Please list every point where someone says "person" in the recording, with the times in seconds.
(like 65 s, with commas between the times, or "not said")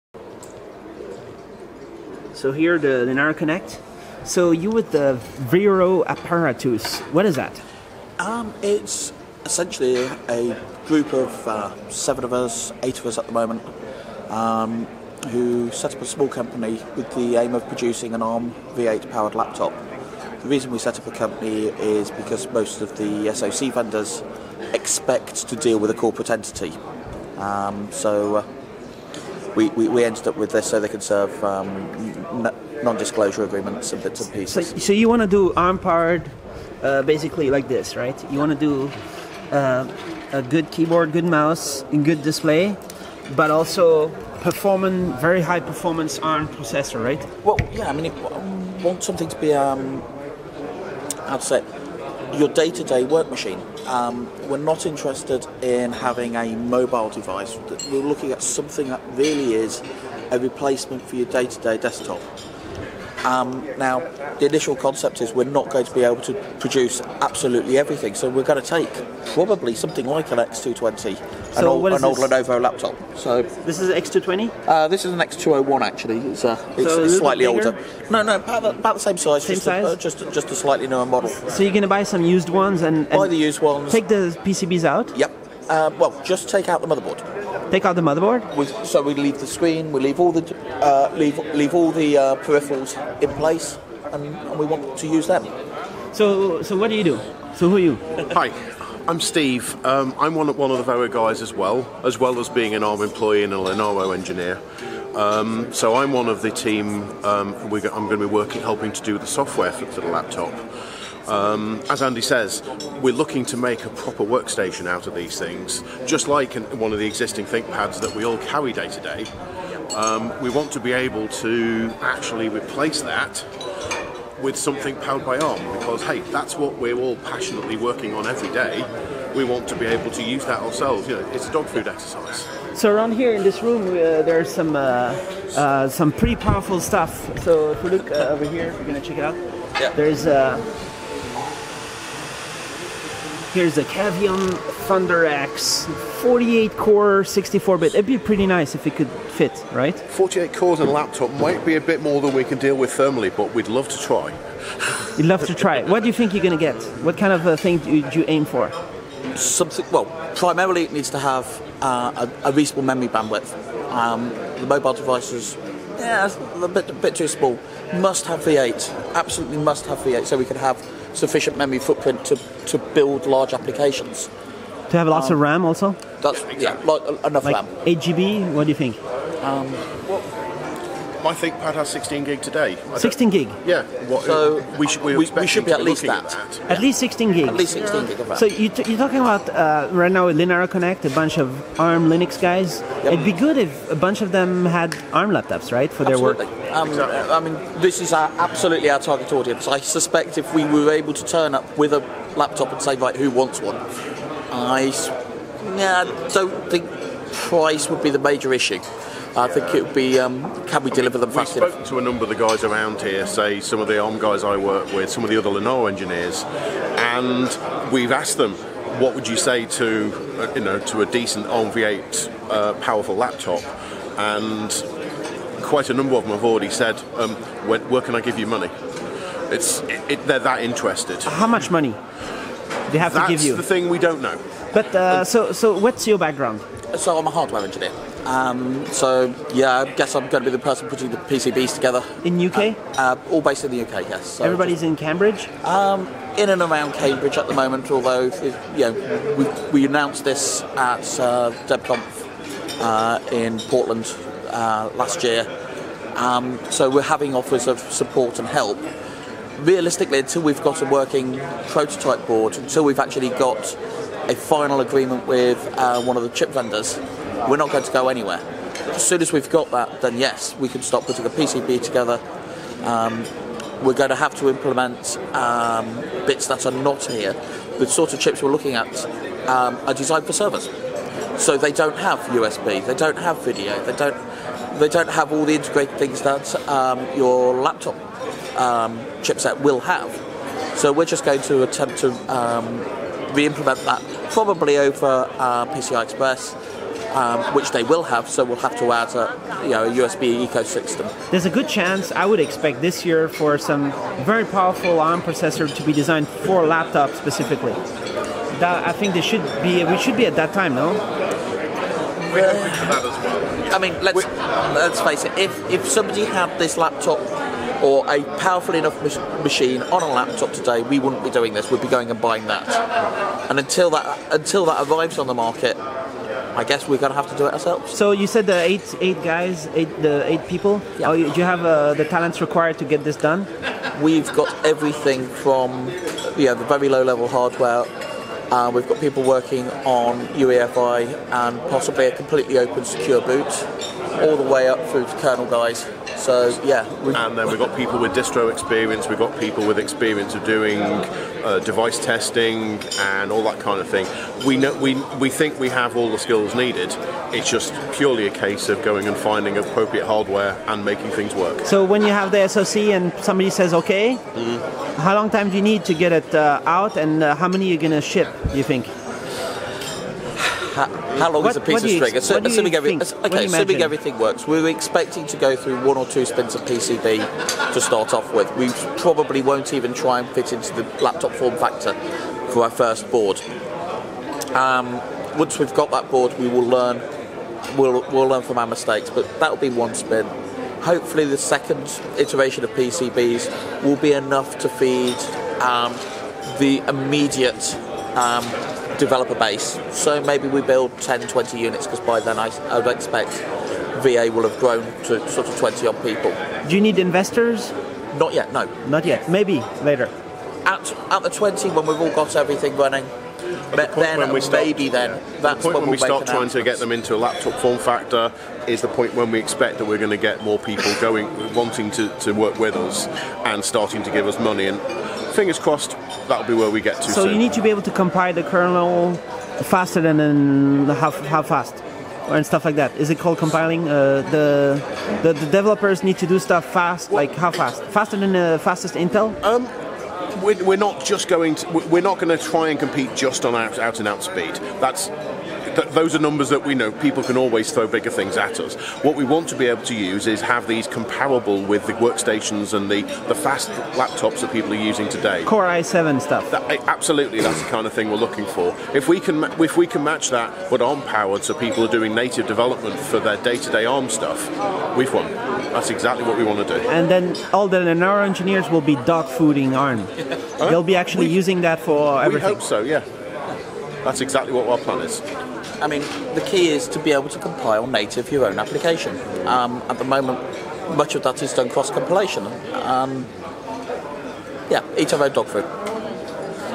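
240 s.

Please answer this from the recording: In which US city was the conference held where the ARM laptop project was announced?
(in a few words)
Portland.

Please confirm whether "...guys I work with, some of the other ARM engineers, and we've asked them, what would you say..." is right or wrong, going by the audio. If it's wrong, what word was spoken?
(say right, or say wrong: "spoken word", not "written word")
wrong: "Linaro", not "ARM".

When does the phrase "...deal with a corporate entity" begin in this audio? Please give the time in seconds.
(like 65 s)
25 s.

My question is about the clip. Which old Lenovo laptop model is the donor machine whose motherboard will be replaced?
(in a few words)
X201.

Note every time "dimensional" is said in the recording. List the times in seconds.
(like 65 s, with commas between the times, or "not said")
not said.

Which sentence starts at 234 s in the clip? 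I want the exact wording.
But uh, um, so so, what's your background?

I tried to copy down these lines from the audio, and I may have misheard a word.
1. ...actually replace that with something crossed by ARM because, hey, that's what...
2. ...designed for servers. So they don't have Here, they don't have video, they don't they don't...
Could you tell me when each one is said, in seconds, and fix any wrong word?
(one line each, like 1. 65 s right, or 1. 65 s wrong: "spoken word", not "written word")
1. 122 s wrong: "powered", not "crossed"
2. 279 s wrong: "USB", not "Here".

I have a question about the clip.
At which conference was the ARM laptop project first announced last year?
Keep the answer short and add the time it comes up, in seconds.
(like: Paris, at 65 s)
DebConf, at 251 s.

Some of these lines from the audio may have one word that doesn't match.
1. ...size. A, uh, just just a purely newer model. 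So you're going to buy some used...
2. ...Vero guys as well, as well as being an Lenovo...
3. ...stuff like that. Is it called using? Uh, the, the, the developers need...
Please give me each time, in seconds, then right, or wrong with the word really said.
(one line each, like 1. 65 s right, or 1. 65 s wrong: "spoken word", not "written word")
1. 79 s wrong: "slightly", not "purely"
2. 100 s wrong: "ARM", not "Lenovo"
3. 432 s wrong: "compiling", not "using".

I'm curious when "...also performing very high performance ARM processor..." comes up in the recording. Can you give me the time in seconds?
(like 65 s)
43 s.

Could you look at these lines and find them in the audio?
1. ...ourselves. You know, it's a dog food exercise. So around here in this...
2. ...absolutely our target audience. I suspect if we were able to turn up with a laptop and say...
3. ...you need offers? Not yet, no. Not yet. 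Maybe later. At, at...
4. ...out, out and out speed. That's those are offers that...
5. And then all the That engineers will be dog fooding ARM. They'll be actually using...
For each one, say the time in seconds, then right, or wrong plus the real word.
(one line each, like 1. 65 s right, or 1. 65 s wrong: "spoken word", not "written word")
1. 130 s right
2. 198 s right
3. 406 s wrong: "investors", not "offers"
4. 443 s wrong: "numbers", not "offers"
5. 466 s wrong: "Linaro", not "That".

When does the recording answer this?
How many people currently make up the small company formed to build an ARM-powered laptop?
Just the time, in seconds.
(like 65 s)
12 s.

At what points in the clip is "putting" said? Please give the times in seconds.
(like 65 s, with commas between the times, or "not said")
240 s, 271 s.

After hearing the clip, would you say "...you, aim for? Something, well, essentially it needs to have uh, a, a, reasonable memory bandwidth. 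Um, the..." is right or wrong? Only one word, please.
wrong.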